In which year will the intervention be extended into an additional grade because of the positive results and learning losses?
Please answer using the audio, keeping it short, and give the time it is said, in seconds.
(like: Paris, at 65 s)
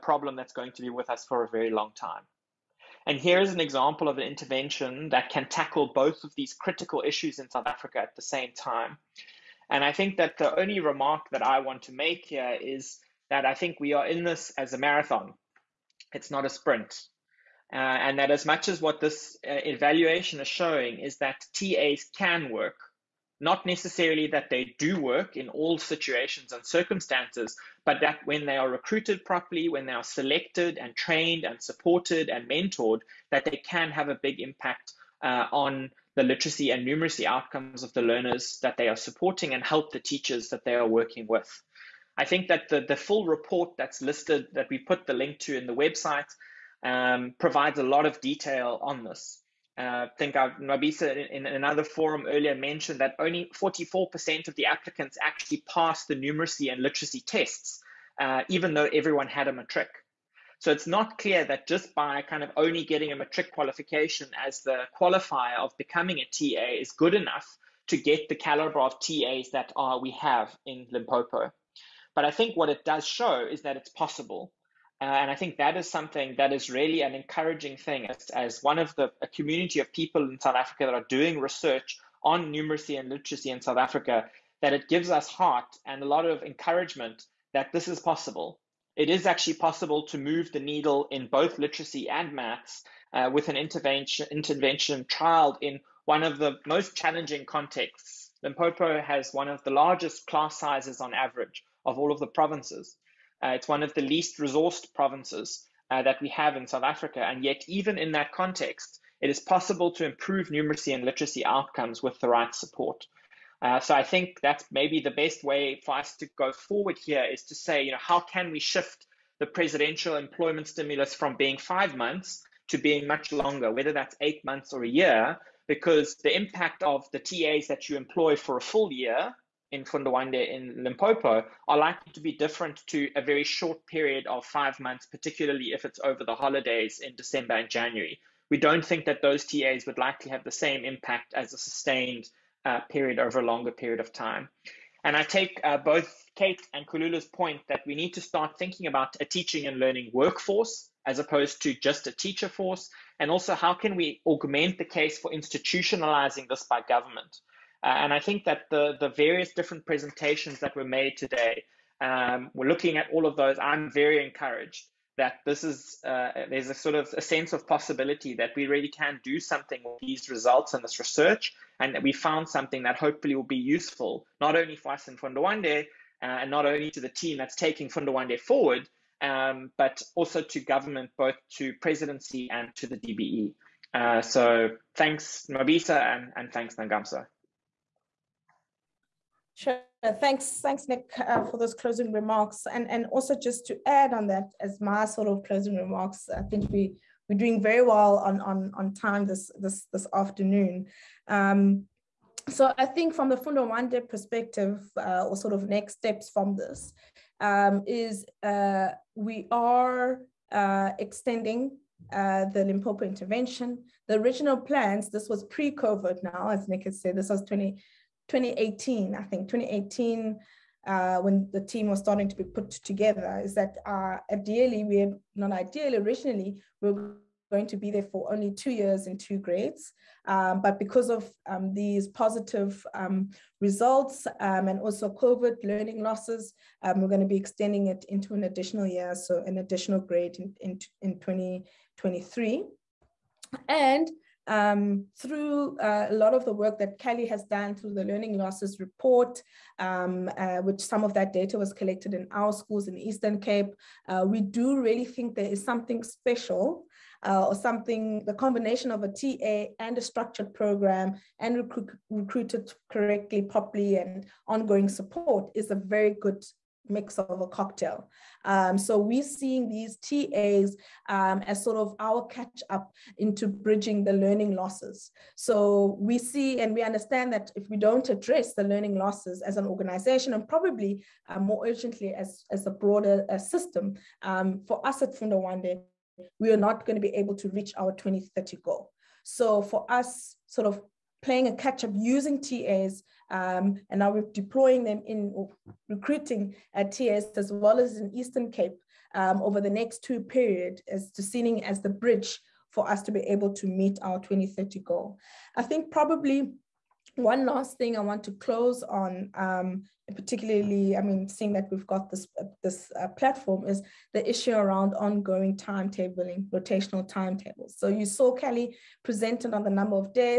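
2023, at 241 s.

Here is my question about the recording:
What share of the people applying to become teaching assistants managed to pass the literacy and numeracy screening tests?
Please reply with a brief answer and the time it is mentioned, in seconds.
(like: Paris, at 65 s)
44%, at 53 s.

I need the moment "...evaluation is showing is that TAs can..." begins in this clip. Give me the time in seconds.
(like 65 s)
19 s.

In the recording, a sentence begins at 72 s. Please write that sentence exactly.
But I think what it does show is that it's possible.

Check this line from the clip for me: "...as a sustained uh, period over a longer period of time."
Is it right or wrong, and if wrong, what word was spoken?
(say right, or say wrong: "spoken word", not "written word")
right.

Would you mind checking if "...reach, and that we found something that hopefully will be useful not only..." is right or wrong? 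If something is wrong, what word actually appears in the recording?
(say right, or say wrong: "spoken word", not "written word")
wrong: "research", not "reach".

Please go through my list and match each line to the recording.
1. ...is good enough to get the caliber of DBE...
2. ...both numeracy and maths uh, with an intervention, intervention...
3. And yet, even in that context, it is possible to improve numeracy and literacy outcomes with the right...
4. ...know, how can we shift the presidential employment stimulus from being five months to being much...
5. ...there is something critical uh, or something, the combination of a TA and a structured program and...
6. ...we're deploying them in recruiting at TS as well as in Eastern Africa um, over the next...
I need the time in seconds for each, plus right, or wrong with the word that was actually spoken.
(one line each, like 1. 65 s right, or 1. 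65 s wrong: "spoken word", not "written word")
1. 66 s wrong: "TAs", not "DBE"
2. 91 s wrong: "literacy", not "numeracy"
3. 107 s right
4. 117 s right
5. 255 s wrong: "special", not "critical"
6. 294 s wrong: "Cape", not "Africa".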